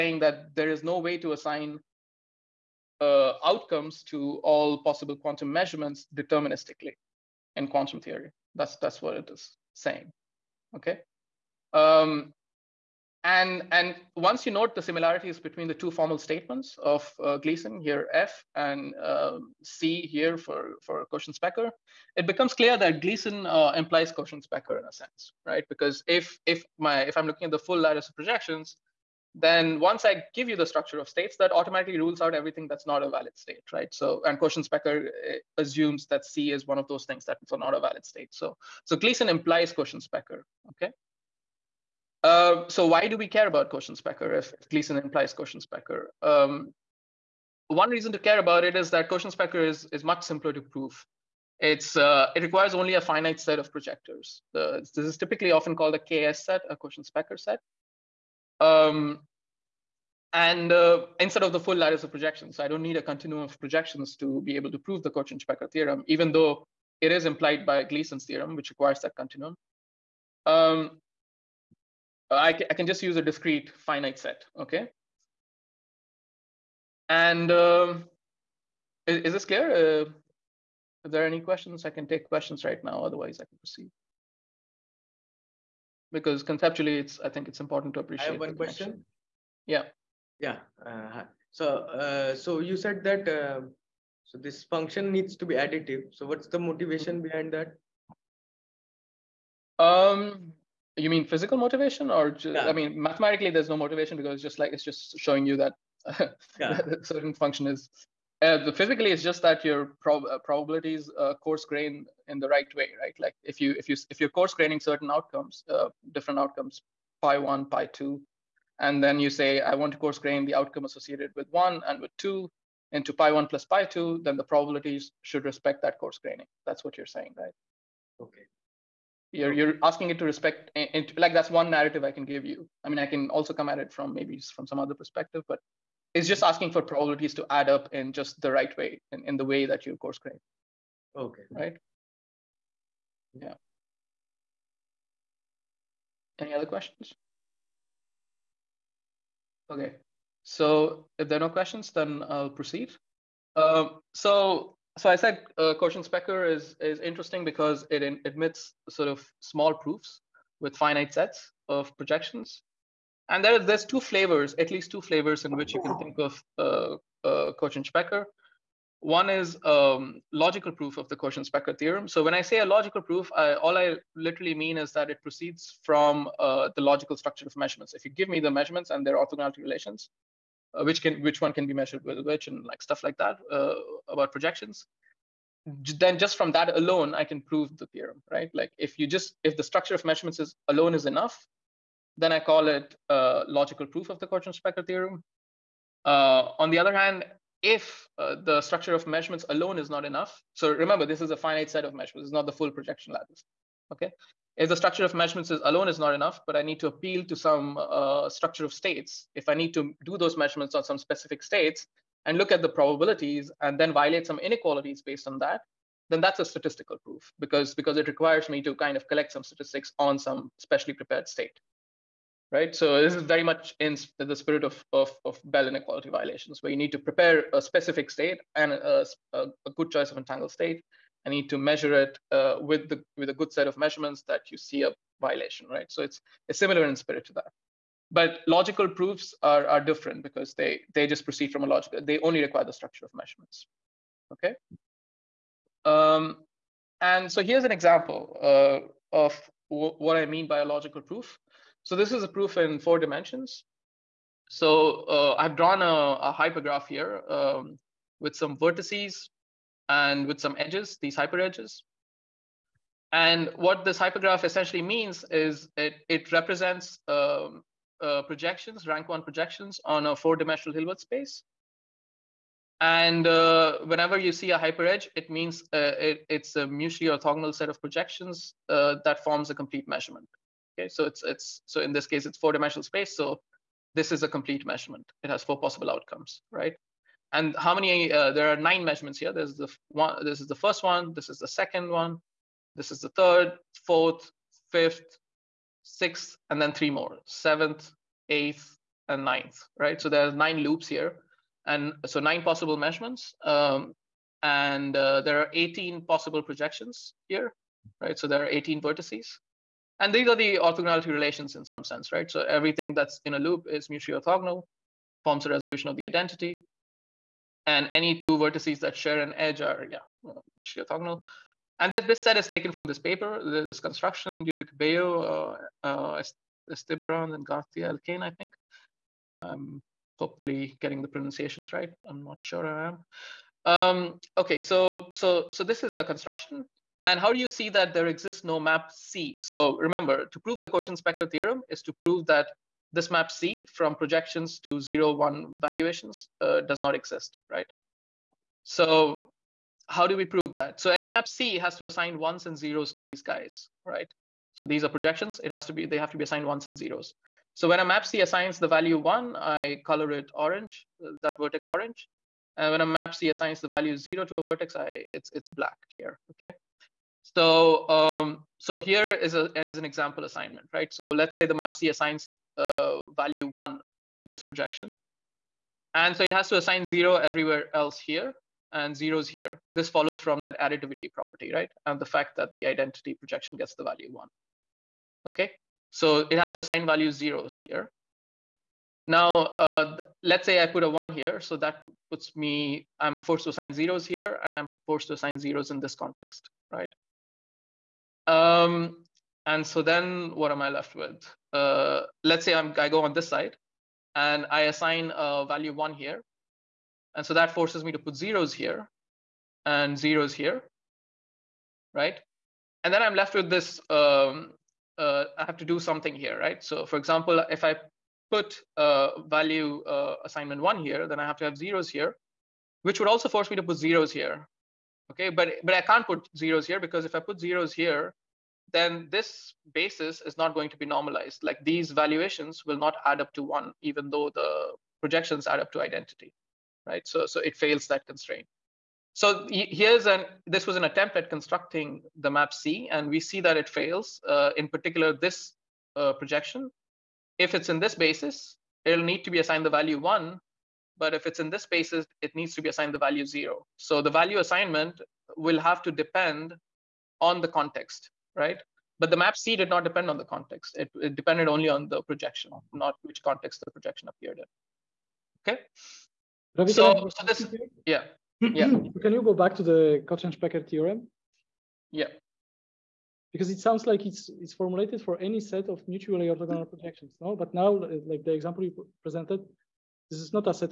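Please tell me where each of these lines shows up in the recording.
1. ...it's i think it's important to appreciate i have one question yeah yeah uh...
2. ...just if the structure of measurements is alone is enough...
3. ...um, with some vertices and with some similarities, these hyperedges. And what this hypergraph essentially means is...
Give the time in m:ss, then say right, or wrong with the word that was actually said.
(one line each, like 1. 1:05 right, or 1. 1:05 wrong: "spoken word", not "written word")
1. 1:26 right
2. 3:09 right
3. 4:17 wrong: "edges", not "similarities".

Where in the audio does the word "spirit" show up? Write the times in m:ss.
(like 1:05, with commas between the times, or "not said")
3:44, 3:56.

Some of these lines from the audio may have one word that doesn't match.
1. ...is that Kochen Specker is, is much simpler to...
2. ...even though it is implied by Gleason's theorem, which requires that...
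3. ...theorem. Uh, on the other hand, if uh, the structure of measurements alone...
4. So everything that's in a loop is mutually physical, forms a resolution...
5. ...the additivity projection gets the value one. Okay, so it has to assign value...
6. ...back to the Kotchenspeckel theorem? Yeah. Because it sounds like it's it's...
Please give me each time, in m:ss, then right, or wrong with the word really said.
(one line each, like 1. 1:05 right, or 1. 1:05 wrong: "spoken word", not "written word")
1. 0:48 right
2. 1:06 right
3. 3:14 right
4. 5:12 wrong: "orthogonal", not "physical"
5. 6:22 wrong: "identity", not "additivity"
6. 7:49 right.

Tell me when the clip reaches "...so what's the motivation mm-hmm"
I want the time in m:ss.
1:36.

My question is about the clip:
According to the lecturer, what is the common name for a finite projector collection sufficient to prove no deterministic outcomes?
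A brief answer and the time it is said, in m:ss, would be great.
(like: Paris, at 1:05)
KS set, at 0:55.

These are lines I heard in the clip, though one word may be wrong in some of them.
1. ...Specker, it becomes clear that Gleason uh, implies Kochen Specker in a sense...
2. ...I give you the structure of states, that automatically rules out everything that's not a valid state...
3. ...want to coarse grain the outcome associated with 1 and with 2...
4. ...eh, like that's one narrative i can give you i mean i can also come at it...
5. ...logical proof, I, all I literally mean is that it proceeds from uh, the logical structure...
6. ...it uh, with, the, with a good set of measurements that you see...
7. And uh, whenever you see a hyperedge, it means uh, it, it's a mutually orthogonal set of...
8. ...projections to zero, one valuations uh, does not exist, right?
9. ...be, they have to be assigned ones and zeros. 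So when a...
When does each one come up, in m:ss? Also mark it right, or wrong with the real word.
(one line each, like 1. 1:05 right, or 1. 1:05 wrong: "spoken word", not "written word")
1. 0:21 right
2. 0:30 right
3. 1:59 right
4. 2:10 right
5. 2:52 right
6. 3:51 right
7. 4:32 right
8. 5:43 right
9. 5:55 right.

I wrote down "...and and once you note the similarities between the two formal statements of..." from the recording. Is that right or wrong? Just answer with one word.
right.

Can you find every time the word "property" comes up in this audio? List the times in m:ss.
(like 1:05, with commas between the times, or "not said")
6:21.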